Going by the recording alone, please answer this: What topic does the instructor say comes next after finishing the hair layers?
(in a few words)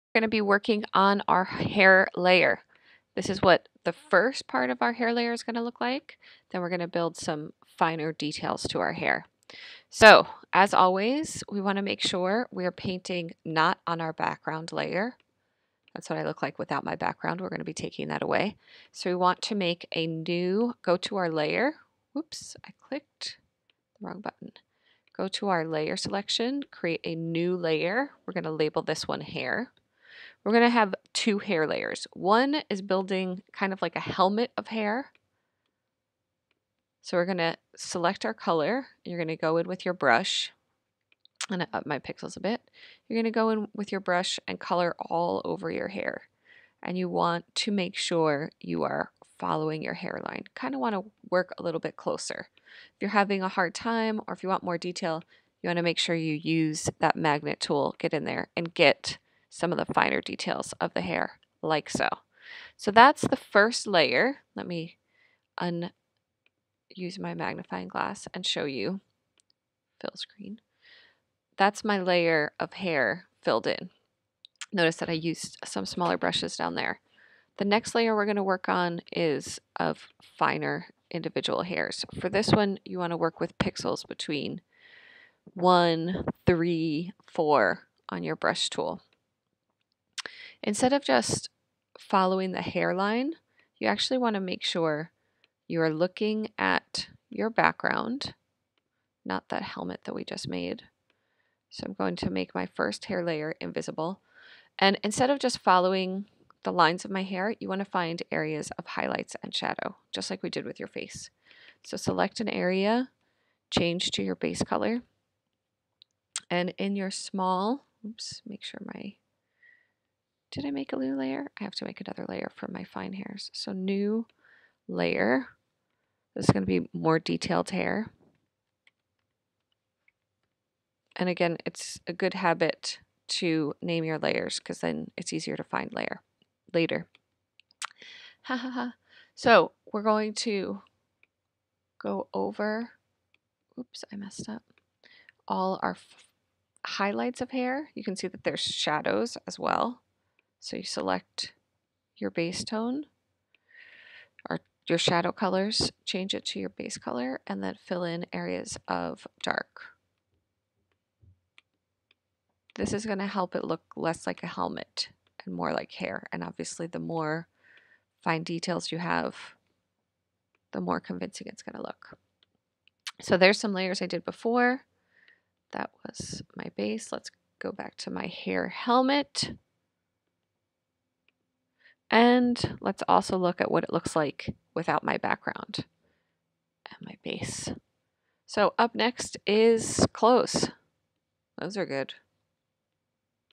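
close.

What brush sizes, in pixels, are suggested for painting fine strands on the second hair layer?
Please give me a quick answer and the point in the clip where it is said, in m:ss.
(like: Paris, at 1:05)
1, 3, 4, at 1:25.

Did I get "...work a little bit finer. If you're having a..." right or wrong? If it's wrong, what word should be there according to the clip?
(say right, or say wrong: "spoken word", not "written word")
wrong: "closer", not "finer".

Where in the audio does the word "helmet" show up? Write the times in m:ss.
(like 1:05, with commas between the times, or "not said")
0:34, 1:39, 2:44, 2:58.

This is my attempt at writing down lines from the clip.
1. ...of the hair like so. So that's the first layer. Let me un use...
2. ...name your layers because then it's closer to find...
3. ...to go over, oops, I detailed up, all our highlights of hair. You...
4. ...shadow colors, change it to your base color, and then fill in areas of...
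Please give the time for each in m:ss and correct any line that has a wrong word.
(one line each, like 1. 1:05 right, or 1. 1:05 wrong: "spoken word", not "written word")
1. 1:00 right
2. 2:13 wrong: "easier", not "closer"
3. 2:20 wrong: "messed", not "detailed"
4. 2:34 right.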